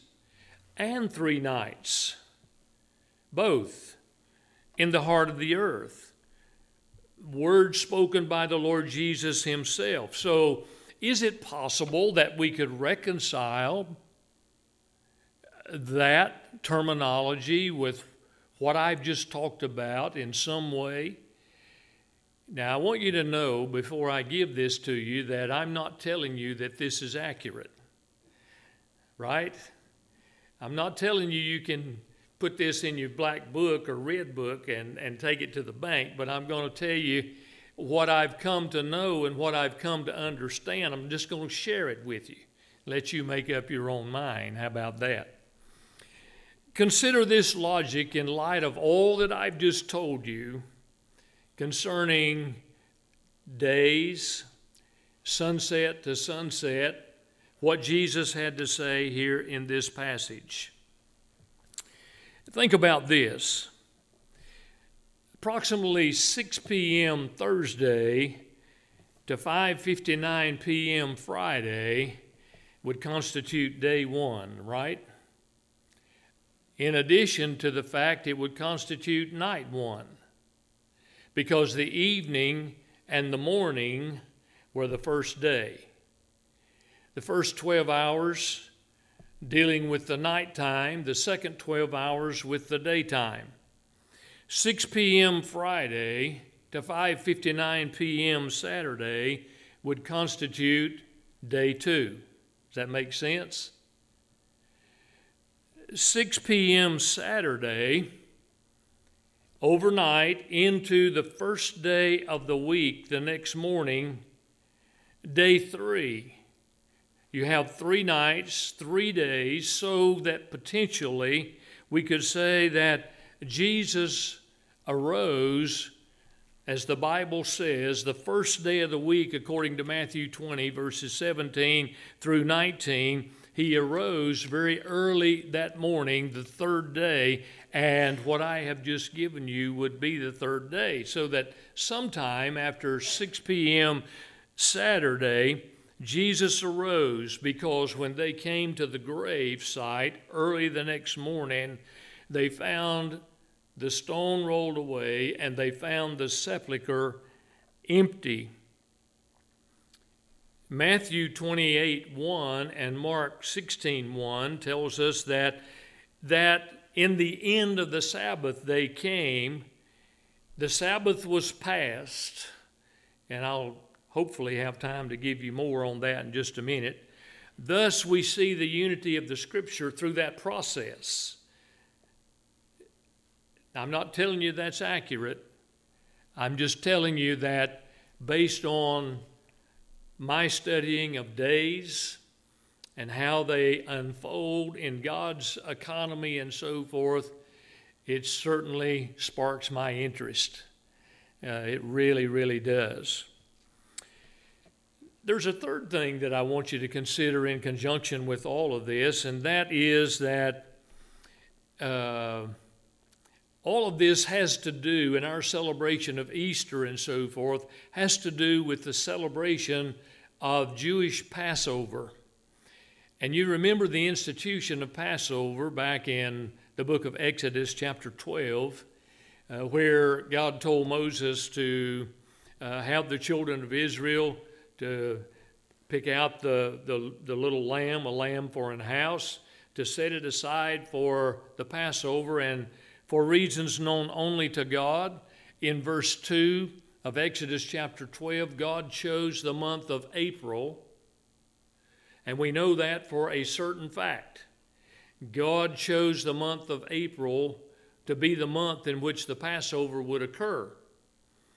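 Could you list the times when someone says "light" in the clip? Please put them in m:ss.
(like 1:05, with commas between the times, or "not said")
0:48.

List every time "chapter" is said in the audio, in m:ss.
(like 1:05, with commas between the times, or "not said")
3:47, 4:07.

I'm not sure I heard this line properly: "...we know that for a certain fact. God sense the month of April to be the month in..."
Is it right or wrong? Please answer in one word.
wrong.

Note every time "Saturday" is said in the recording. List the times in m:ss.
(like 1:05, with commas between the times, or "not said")
1:38, 1:46, 2:24.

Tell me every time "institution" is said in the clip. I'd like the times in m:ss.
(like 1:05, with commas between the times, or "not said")
3:44.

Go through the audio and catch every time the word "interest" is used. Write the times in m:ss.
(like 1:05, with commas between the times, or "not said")
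3:19.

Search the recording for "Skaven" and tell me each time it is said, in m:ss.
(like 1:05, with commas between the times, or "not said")
not said.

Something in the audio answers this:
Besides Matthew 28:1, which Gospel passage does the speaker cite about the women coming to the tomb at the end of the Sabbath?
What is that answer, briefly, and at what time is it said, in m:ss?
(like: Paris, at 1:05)
Mark 16:1, at 2:42.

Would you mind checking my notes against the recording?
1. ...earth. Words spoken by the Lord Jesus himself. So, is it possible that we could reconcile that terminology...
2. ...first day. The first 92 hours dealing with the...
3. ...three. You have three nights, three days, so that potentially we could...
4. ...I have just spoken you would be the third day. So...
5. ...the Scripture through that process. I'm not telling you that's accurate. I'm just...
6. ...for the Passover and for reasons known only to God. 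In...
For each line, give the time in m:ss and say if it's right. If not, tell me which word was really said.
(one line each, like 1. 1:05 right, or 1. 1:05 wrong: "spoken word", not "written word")
1. 0:05 right
2. 1:24 wrong: "12", not "92"
3. 1:55 right
4. 2:18 wrong: "given", not "spoken"
5. 2:59 right
6. 4:00 right.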